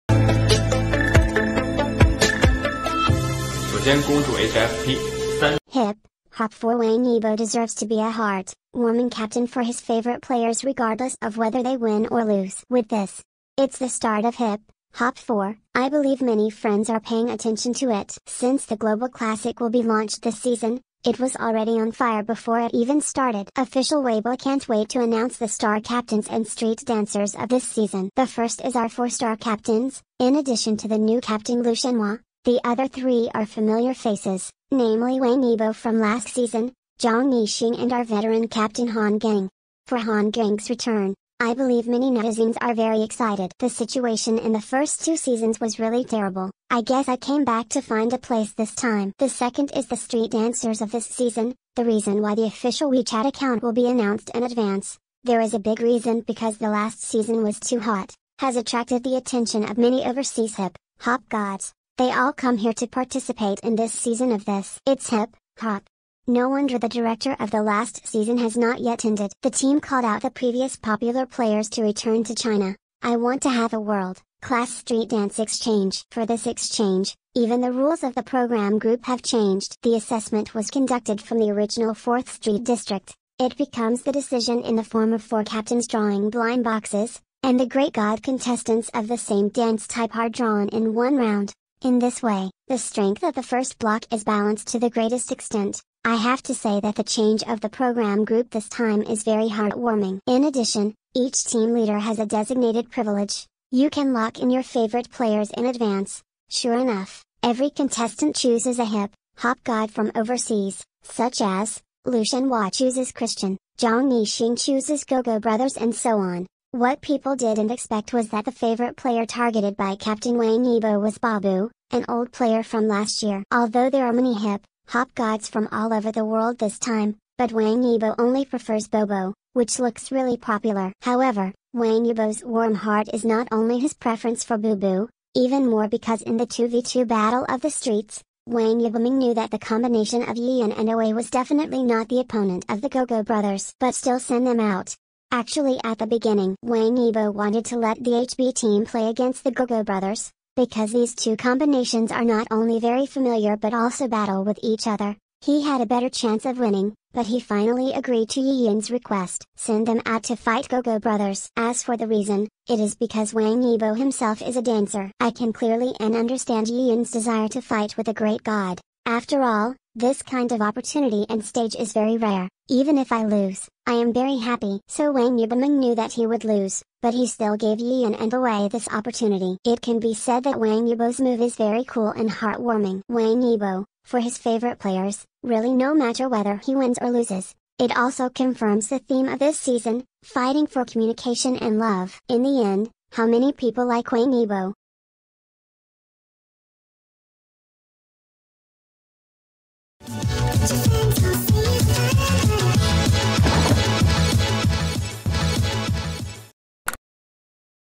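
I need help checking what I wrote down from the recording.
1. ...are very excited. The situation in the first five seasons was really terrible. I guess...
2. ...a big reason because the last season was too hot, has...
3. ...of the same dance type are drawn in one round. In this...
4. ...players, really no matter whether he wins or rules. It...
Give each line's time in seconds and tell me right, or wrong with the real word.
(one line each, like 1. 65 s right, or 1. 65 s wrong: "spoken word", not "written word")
1. 42 s wrong: "two", not "five"
2. 55 s right
3. 88 s right
4. 184 s wrong: "loses", not "rules".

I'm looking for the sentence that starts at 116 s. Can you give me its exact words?
What people didn't expect was that the favorite player targeted by Captain Wang Yibo was Babu, an old player from last year.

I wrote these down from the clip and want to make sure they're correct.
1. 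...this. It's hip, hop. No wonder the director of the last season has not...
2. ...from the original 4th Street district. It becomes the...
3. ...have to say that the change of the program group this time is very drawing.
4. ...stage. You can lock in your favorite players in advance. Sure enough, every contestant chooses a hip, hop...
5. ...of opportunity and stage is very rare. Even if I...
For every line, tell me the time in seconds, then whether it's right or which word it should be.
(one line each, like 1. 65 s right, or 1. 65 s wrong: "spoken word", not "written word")
1. 64 s right
2. 81 s right
3. 96 s wrong: "heartwarming", not "drawing"
4. 102 s wrong: "privilege", not "stage"
5. 170 s right.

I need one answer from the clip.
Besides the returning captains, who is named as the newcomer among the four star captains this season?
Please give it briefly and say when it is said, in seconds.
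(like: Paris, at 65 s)
Lu Shenhua, at 31 s.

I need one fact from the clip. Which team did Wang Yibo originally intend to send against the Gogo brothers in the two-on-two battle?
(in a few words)
HB team.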